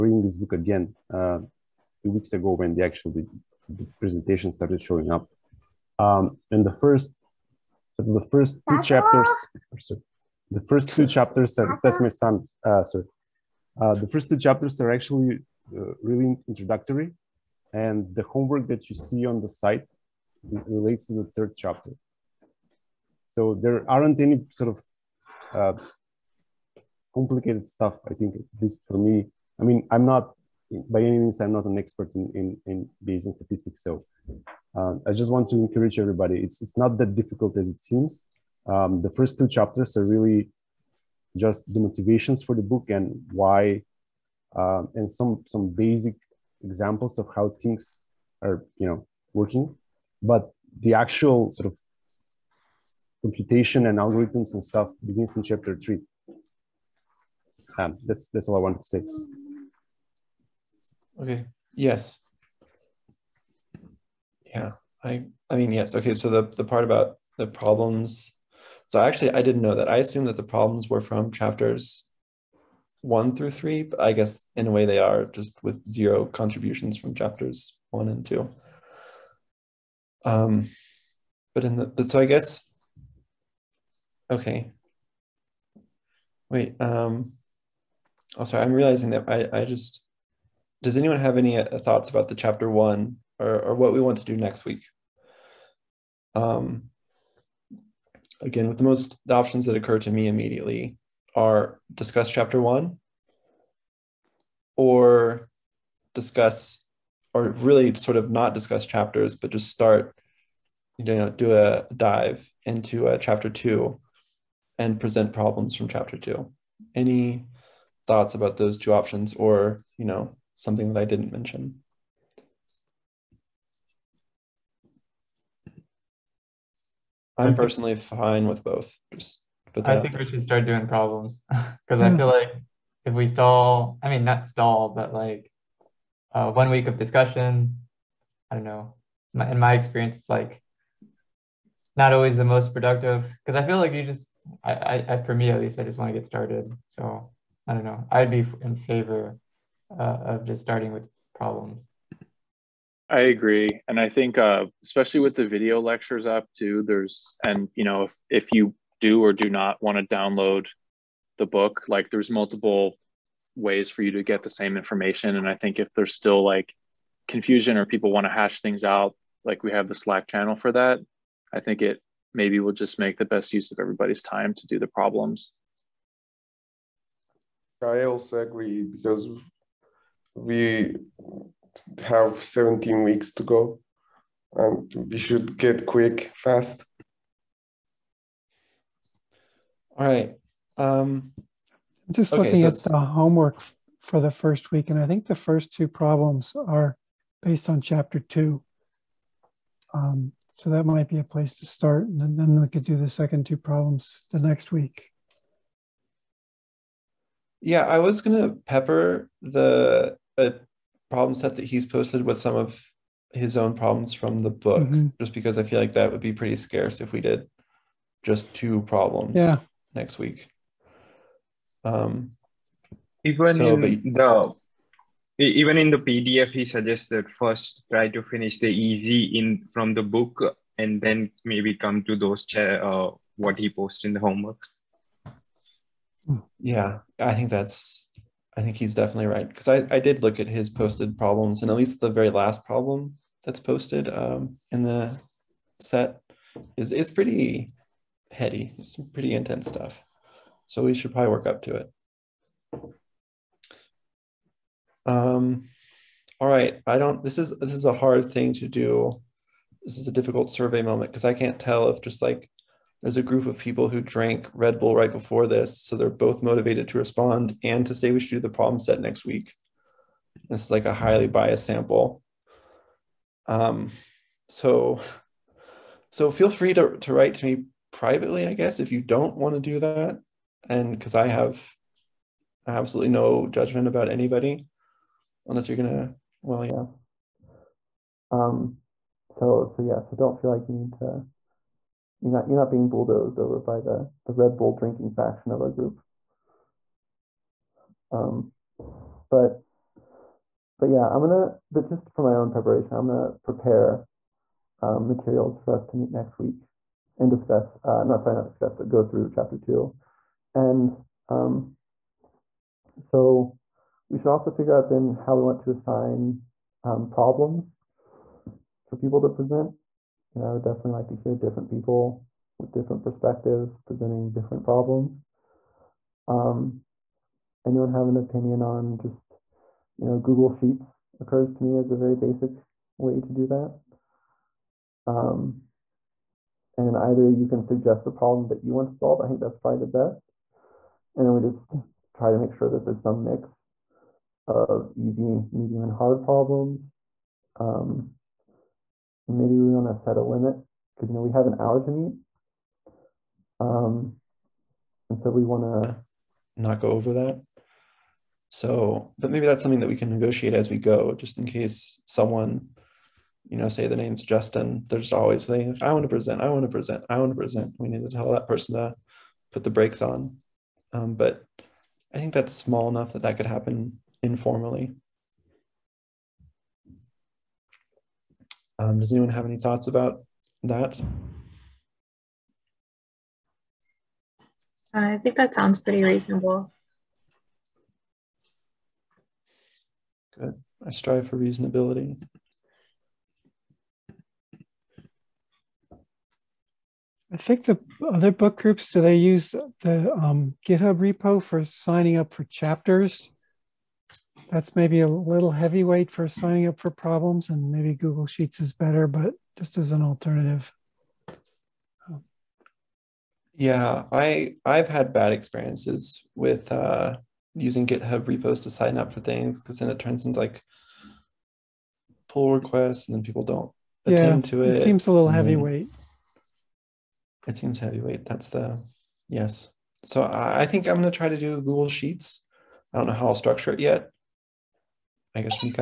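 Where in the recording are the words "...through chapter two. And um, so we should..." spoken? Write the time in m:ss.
5:09.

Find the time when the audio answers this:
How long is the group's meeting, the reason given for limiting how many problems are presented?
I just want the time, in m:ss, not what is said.
5:51.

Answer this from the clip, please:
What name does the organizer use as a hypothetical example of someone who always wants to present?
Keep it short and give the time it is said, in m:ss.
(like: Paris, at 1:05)
Justin, at 6:04.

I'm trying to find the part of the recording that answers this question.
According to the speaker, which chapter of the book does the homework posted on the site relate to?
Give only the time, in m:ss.
0:21.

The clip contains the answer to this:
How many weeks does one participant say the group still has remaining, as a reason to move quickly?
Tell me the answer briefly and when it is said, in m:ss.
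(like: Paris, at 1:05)
17, at 3:02.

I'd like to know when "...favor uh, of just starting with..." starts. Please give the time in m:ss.
2:28.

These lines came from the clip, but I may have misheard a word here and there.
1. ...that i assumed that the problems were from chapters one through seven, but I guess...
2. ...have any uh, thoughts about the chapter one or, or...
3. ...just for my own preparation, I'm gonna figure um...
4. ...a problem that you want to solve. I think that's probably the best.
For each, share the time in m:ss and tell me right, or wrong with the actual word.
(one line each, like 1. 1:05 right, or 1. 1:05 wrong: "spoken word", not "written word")
1. 1:09 wrong: "three", not "seven"
2. 1:31 right
3. 5:01 wrong: "prepare", not "figure"
4. 5:38 right.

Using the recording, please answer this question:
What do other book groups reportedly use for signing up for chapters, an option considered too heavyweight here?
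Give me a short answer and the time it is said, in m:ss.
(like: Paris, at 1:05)
GitHub repo, at 6:40.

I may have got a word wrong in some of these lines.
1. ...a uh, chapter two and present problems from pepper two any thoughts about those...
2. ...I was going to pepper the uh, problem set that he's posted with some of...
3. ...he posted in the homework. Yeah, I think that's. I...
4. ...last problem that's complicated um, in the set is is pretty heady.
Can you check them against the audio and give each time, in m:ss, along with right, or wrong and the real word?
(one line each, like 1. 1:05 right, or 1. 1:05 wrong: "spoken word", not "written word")
1. 1:53 wrong: "chapter", not "pepper"
2. 3:27 right
3. 3:53 right
4. 4:02 wrong: "posted", not "complicated".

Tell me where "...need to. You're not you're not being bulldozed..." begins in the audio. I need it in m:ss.
4:50.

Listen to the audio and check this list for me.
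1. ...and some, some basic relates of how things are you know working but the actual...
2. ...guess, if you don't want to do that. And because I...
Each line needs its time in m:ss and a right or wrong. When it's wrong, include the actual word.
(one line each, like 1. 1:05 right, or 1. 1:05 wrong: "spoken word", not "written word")
1. 0:44 wrong: "examples", not "relates"
2. 4:38 right.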